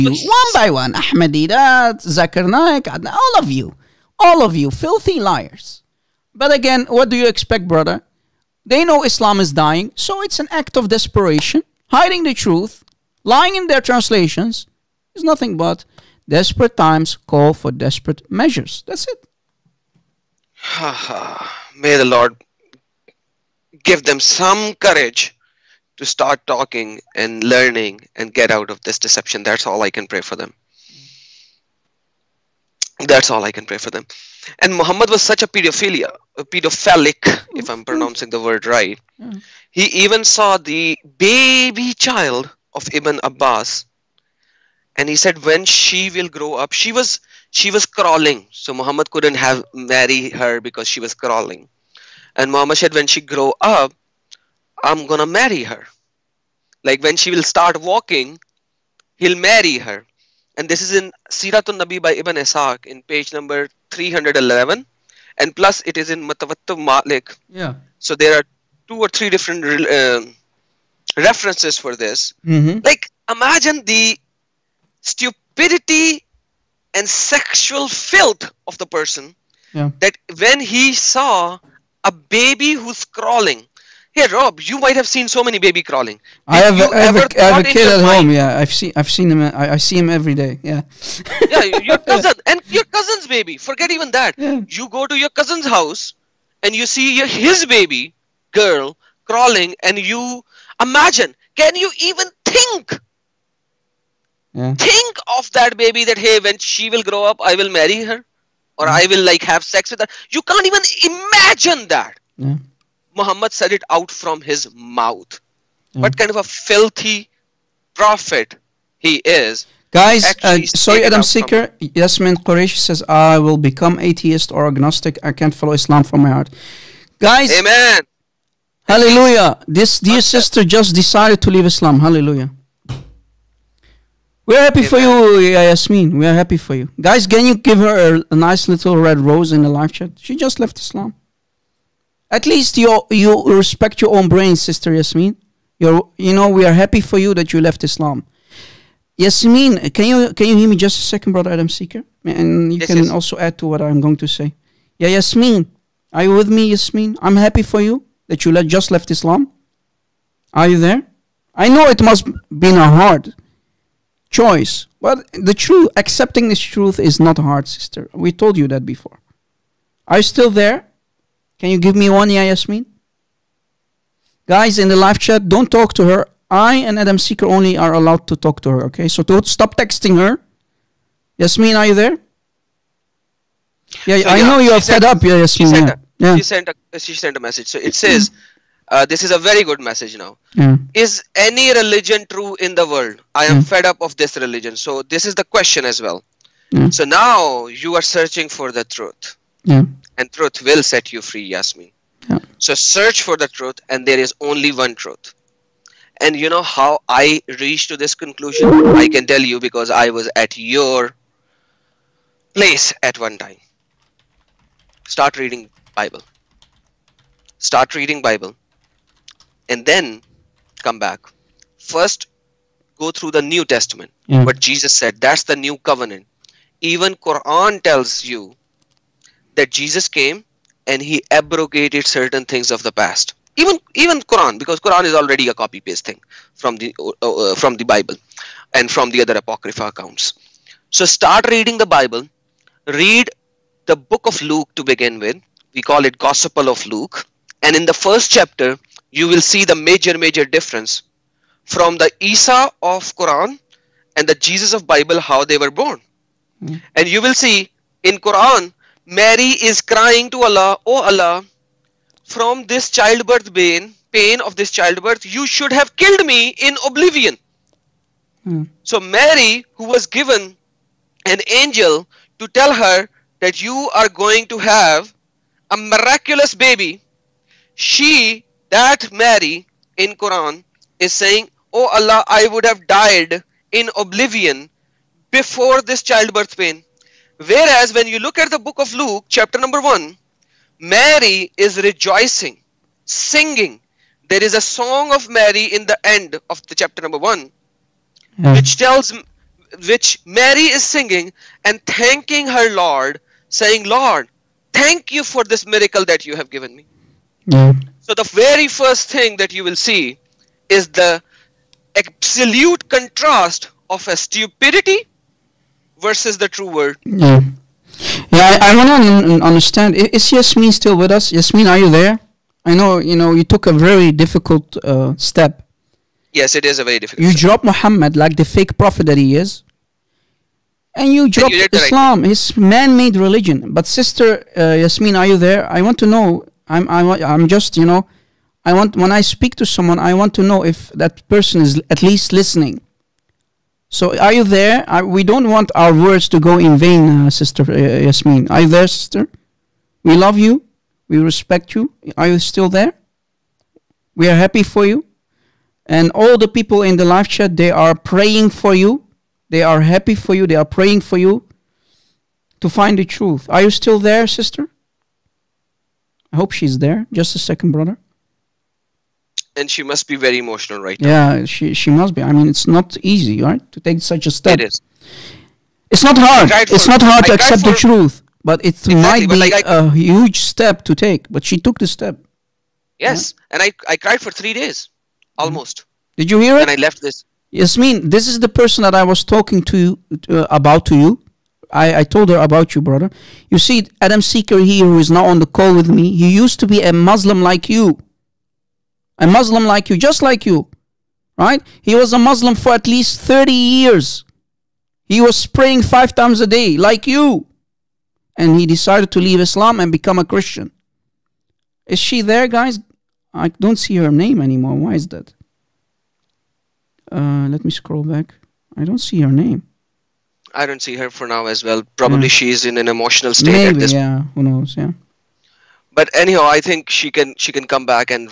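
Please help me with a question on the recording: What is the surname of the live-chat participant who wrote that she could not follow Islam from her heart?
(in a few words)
Qureshi.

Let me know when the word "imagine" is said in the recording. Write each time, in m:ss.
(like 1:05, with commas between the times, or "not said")
1:13, 1:40, 1:51.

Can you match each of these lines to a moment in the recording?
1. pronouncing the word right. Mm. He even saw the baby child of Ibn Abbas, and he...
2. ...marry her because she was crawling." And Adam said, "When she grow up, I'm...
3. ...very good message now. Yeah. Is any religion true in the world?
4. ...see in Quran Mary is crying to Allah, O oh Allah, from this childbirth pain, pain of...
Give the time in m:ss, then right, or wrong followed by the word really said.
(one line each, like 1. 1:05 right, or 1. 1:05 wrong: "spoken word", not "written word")
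1. 0:37 right
2. 0:49 wrong: "Muhammad", not "Adam"
3. 3:09 right
4. 4:17 right.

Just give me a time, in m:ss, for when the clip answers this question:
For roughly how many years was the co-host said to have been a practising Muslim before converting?
6:43.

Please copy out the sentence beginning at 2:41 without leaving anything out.
I know it must be a hard choice, but the truth, accepting this truth, is not hard, sister.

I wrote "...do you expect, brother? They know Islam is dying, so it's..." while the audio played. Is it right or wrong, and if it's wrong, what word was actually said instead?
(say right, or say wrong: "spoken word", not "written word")
right.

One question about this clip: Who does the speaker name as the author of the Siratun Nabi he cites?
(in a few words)
Ibn Ishaq.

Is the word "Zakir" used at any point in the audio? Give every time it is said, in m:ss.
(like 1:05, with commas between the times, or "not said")
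0:02.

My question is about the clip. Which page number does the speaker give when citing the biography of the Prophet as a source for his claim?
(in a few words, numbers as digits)
311.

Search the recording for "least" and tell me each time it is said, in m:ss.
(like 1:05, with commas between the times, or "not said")
2:22, 5:42, 6:42.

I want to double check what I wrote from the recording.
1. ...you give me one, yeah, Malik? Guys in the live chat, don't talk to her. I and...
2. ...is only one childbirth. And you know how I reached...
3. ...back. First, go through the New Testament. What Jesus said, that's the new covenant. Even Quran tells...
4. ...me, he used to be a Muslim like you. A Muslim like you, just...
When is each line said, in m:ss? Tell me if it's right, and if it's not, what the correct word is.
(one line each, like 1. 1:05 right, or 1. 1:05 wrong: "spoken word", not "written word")
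1. 2:51 wrong: "Yasmin", not "Malik"
2. 3:24 wrong: "truth", not "childbirth"
3. 3:41 right
4. 6:35 right.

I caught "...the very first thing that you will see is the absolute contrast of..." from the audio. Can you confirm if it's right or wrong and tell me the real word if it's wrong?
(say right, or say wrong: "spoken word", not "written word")
right.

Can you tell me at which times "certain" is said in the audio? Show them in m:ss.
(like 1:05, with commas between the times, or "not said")
3:52.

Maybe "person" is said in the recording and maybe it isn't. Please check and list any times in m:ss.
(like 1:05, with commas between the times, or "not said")
1:18, 5:41, 6:28.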